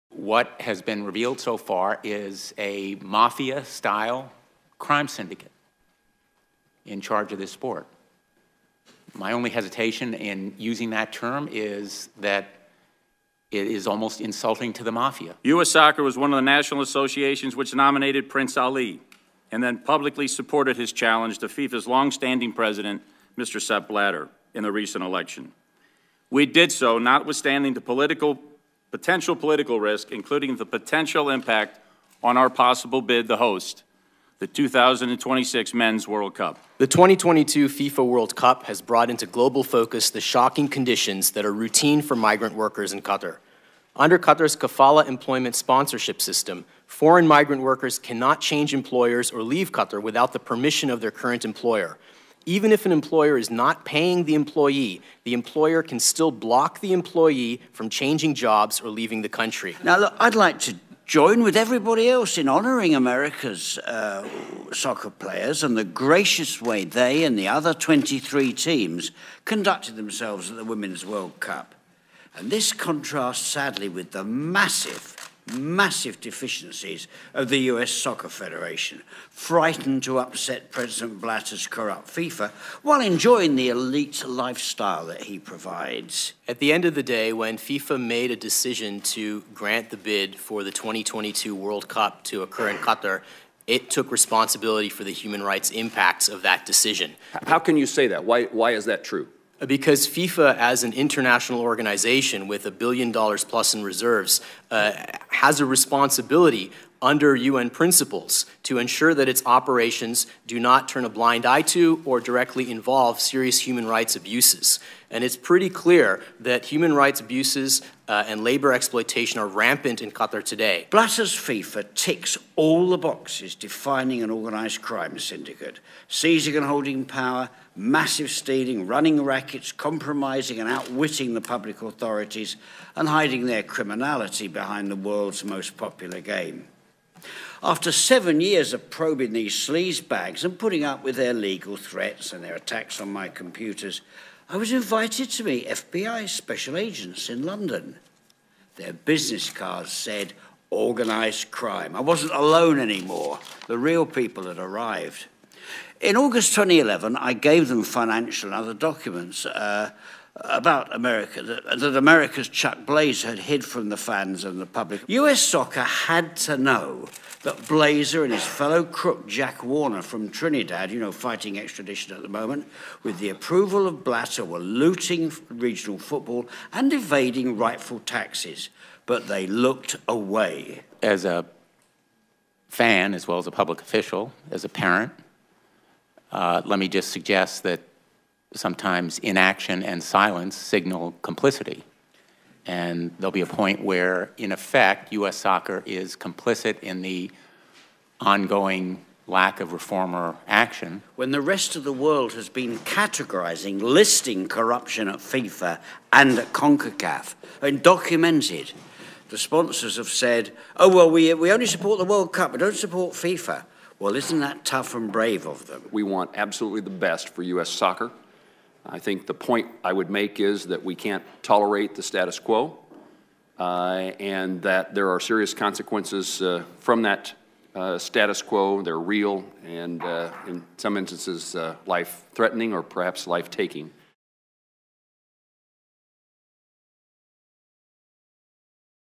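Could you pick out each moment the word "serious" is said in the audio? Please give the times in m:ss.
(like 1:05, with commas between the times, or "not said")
1:53, 3:45.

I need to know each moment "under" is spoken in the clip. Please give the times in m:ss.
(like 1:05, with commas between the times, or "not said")
0:43, 1:47.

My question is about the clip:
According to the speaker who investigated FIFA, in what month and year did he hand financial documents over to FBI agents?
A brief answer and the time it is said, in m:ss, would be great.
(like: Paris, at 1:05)
August 2011, at 2:36.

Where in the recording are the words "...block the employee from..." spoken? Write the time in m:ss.
0:56.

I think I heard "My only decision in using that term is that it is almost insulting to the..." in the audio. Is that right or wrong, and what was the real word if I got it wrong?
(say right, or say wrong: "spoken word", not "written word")
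wrong: "hesitation", not "decision".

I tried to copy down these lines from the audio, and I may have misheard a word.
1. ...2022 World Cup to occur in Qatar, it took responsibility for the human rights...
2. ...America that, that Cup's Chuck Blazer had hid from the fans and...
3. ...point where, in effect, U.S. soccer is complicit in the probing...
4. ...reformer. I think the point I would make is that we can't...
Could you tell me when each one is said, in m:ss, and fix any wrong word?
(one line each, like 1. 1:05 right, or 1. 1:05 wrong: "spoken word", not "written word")
1. 1:30 right
2. 2:40 wrong: "America", not "Cup"
3. 3:13 wrong: "ongoing", not "probing"
4. 3:37 wrong: "soccer", not "reformer".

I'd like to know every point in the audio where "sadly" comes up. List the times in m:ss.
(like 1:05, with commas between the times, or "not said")
1:13.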